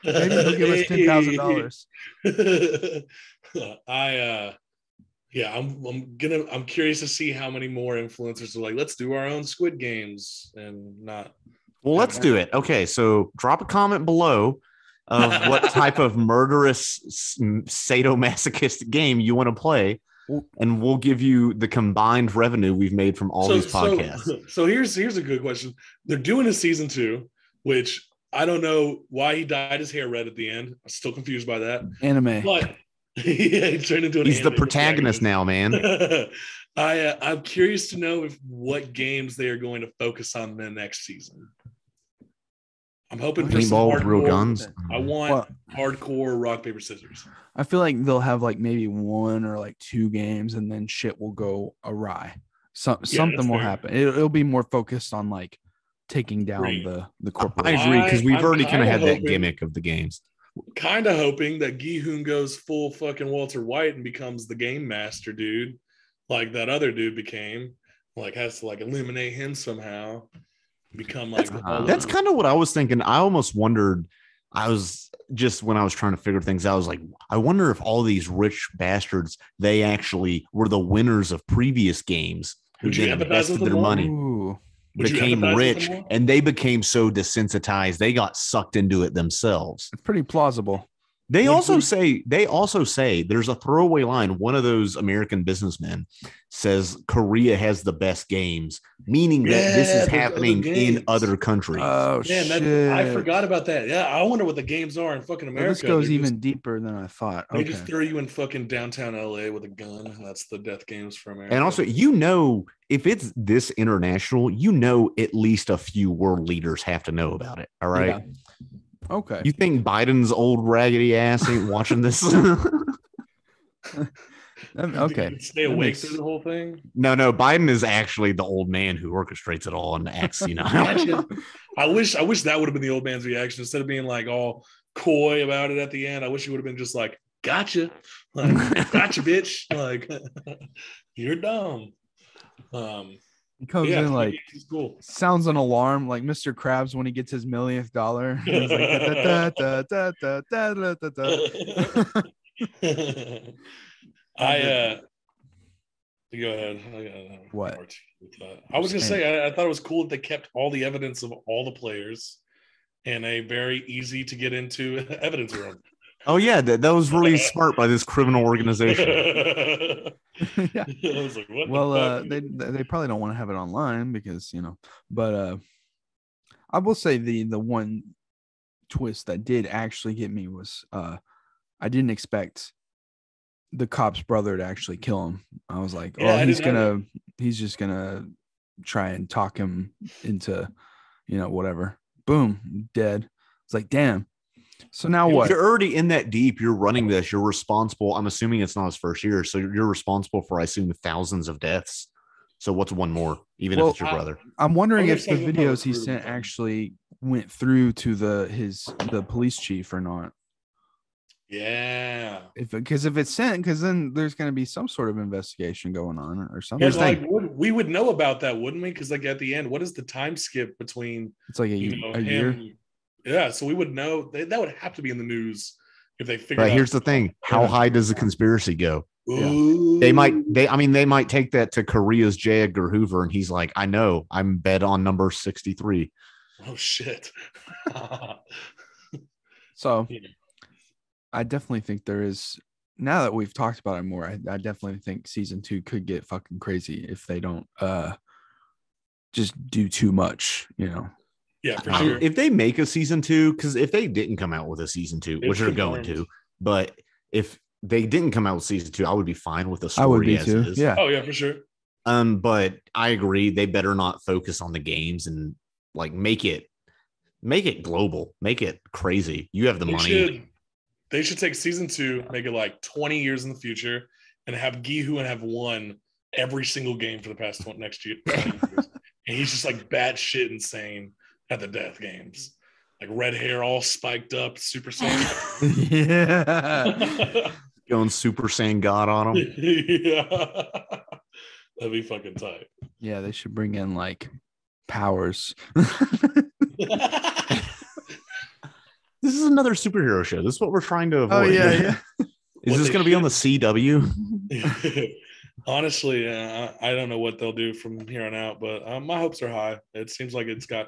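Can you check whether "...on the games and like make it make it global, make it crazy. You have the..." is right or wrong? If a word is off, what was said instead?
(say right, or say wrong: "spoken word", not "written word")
right.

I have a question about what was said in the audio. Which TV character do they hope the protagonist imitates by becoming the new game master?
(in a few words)
Walter White.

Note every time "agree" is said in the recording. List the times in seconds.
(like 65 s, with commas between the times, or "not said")
57 s, 263 s.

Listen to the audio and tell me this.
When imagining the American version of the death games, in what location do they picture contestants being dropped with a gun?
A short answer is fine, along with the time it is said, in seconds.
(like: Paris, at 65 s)
downtown LA, at 108 s.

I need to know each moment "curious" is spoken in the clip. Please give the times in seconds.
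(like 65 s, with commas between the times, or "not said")
6 s, 37 s.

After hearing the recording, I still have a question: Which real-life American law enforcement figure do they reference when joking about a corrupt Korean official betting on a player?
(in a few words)
J. Edgar Hoover.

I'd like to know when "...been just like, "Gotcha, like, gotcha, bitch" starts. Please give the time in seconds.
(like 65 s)
136 s.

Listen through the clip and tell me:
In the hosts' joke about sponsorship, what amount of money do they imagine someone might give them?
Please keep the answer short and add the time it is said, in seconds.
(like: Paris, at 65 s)
$10,000, at 0 s.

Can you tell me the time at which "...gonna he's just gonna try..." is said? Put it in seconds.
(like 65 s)
186 s.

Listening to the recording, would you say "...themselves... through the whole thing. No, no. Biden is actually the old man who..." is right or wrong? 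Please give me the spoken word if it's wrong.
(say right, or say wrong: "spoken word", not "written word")
wrong: "makes", not "themselves".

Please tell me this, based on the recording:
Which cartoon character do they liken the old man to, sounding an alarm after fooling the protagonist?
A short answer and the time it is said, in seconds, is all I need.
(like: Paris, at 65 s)
Mr. Krabs, at 146 s.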